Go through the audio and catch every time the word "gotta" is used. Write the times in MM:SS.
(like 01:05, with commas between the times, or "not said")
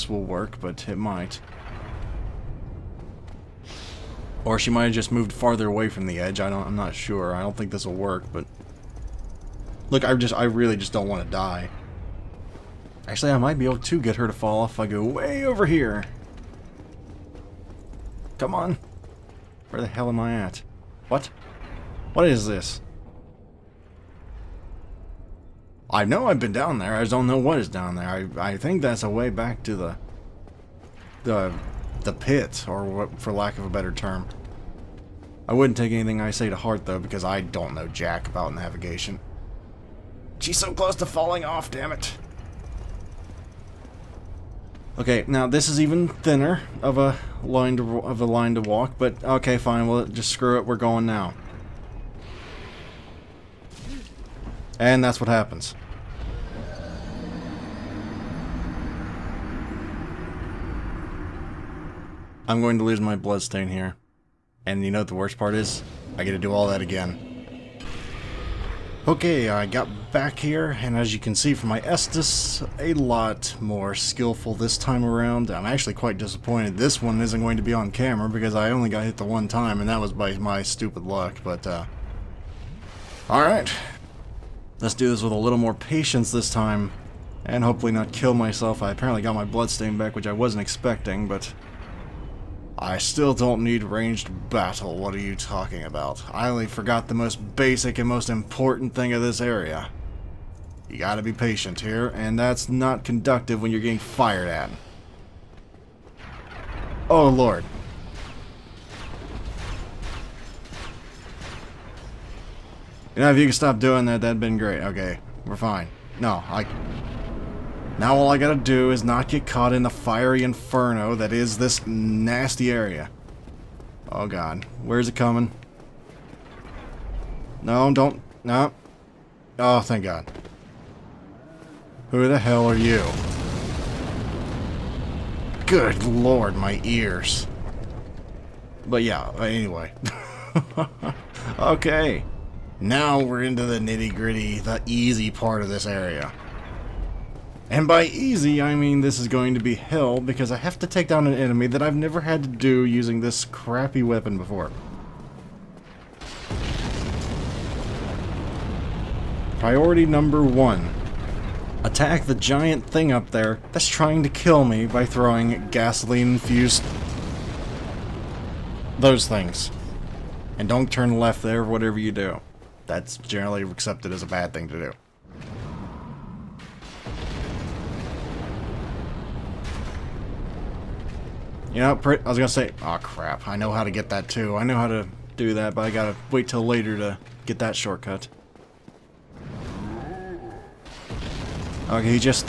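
01:40, 01:58, 03:05.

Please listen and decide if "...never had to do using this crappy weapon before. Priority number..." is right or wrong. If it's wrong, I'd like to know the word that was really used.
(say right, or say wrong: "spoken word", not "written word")
right.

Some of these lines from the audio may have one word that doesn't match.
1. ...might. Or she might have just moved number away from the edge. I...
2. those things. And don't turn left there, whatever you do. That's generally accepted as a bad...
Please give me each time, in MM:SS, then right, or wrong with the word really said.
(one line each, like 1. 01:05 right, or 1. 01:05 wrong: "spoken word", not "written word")
1. 00:00 wrong: "farther", not "number"
2. 02:48 right.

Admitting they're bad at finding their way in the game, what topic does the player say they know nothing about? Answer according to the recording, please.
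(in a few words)
Navigation.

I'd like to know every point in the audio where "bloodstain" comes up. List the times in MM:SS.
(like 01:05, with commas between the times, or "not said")
01:03, 01:29.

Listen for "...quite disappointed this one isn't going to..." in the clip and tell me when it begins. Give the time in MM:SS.
01:15.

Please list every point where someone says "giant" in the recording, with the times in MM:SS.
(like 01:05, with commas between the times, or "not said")
02:42.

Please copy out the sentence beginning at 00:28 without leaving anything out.
I, I think that's a way back to the...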